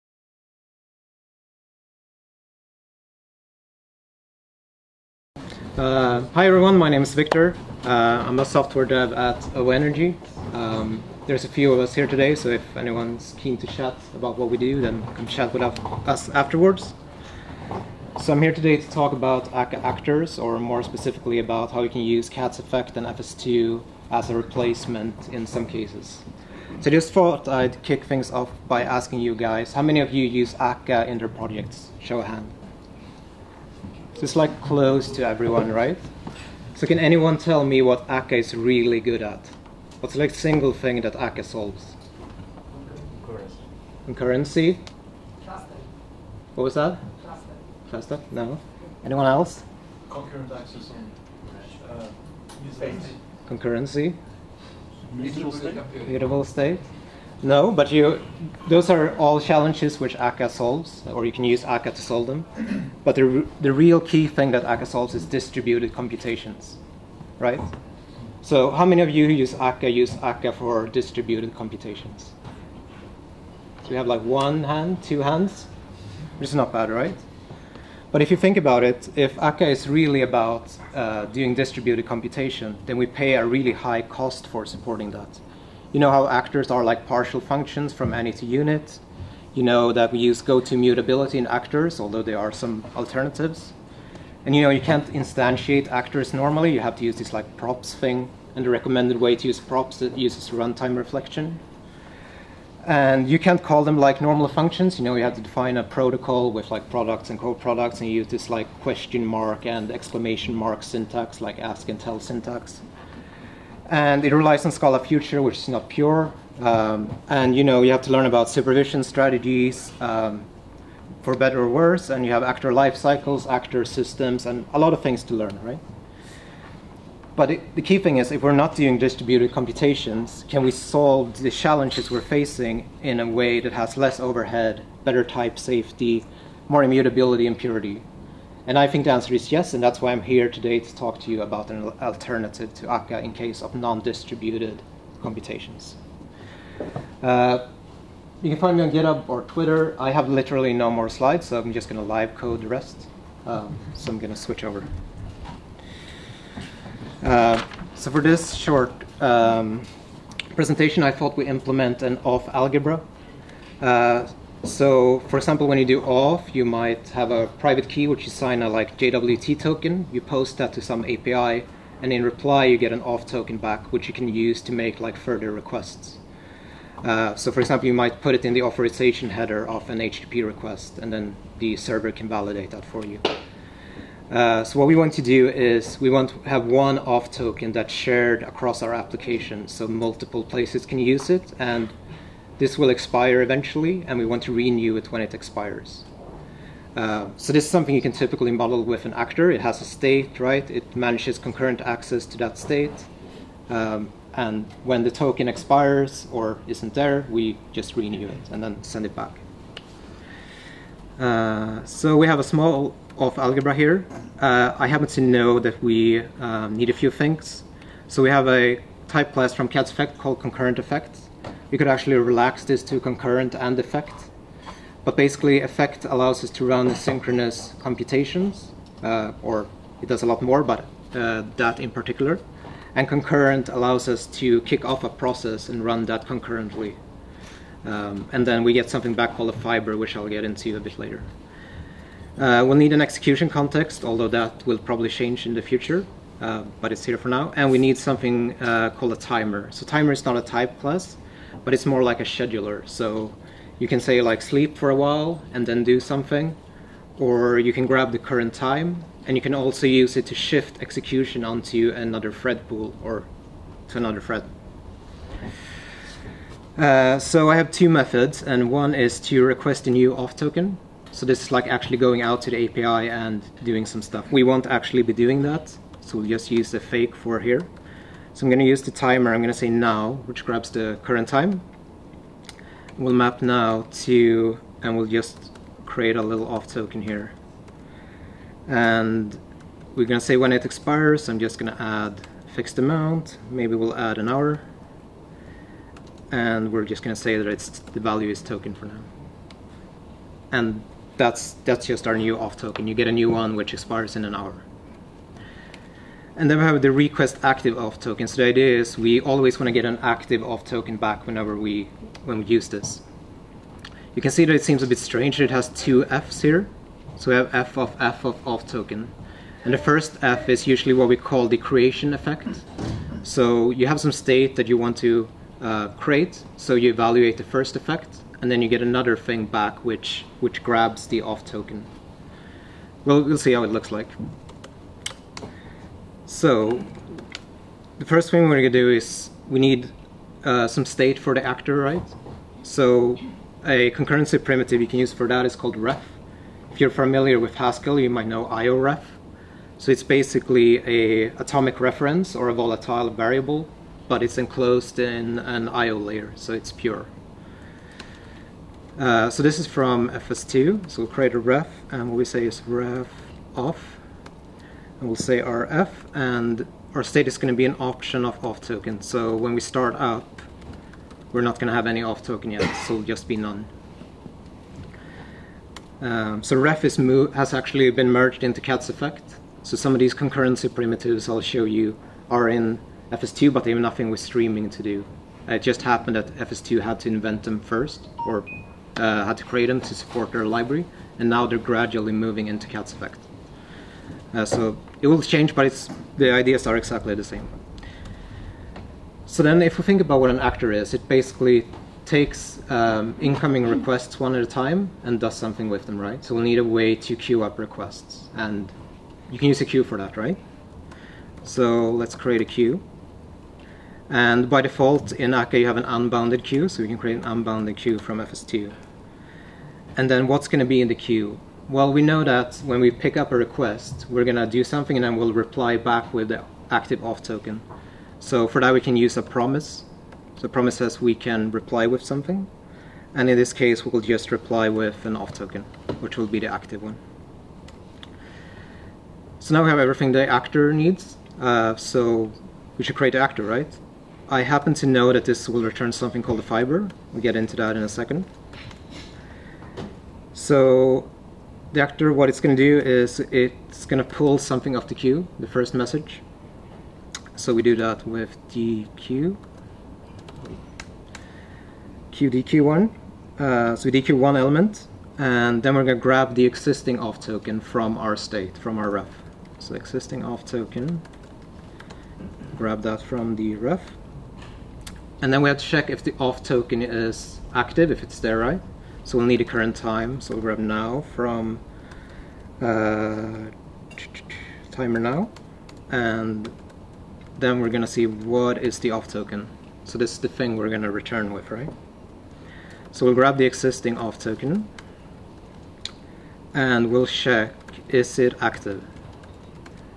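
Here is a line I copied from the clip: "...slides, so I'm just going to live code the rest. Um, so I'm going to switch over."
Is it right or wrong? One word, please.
right.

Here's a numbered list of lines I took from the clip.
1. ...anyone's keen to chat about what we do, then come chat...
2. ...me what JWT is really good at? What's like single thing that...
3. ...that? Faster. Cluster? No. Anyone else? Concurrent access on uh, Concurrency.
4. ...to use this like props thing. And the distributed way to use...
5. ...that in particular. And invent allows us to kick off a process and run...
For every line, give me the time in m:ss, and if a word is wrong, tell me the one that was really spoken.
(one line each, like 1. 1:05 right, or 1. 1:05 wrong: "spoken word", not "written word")
1. 0:12 right
2. 0:37 wrong: "Akka", not "JWT"
3. 0:46 right
4. 1:36 wrong: "recommended", not "distributed"
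5. 3:51 wrong: "concurrent", not "invent".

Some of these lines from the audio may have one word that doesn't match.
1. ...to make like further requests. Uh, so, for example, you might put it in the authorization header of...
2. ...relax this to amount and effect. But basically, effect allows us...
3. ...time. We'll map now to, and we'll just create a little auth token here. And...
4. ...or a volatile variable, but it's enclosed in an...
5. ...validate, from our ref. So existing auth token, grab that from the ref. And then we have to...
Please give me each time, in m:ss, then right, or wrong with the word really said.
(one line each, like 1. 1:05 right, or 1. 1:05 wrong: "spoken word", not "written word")
1. 2:54 right
2. 3:42 wrong: "concurrent", not "amount"
3. 4:41 right
4. 5:52 right
5. 7:48 wrong: "state", not "validate".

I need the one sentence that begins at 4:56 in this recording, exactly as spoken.
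And we're just going to say that it's the value is token for now.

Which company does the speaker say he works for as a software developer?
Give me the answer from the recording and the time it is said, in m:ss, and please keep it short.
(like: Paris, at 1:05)
OVO Energy, at 0:09.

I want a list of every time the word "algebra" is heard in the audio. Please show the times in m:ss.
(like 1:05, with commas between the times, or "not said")
2:42, 3:33.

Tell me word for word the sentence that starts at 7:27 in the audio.
We'll get into that in a second.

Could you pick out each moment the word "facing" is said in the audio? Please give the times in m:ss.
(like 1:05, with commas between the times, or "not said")
2:12.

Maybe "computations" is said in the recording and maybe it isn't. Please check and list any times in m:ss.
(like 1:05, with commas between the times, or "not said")
1:05, 1:11, 1:22, 2:09, 2:25, 3:47.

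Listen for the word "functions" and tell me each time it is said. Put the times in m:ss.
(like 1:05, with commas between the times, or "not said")
1:27, 1:44.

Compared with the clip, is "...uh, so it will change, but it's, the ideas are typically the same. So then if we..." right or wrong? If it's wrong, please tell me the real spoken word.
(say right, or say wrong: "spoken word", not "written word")
wrong: "exactly", not "typically".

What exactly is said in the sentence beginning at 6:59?
And then what's going to be in the queue?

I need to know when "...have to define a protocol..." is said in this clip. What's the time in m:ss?
1:45.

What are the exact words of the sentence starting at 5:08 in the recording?
So the idea is we always want to get an active auth token back whenever we when we use this.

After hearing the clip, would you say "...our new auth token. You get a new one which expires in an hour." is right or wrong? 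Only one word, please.
right.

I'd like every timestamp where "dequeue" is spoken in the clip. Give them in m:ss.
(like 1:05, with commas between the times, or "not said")
7:38, 7:44.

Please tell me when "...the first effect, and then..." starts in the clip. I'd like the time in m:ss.
5:27.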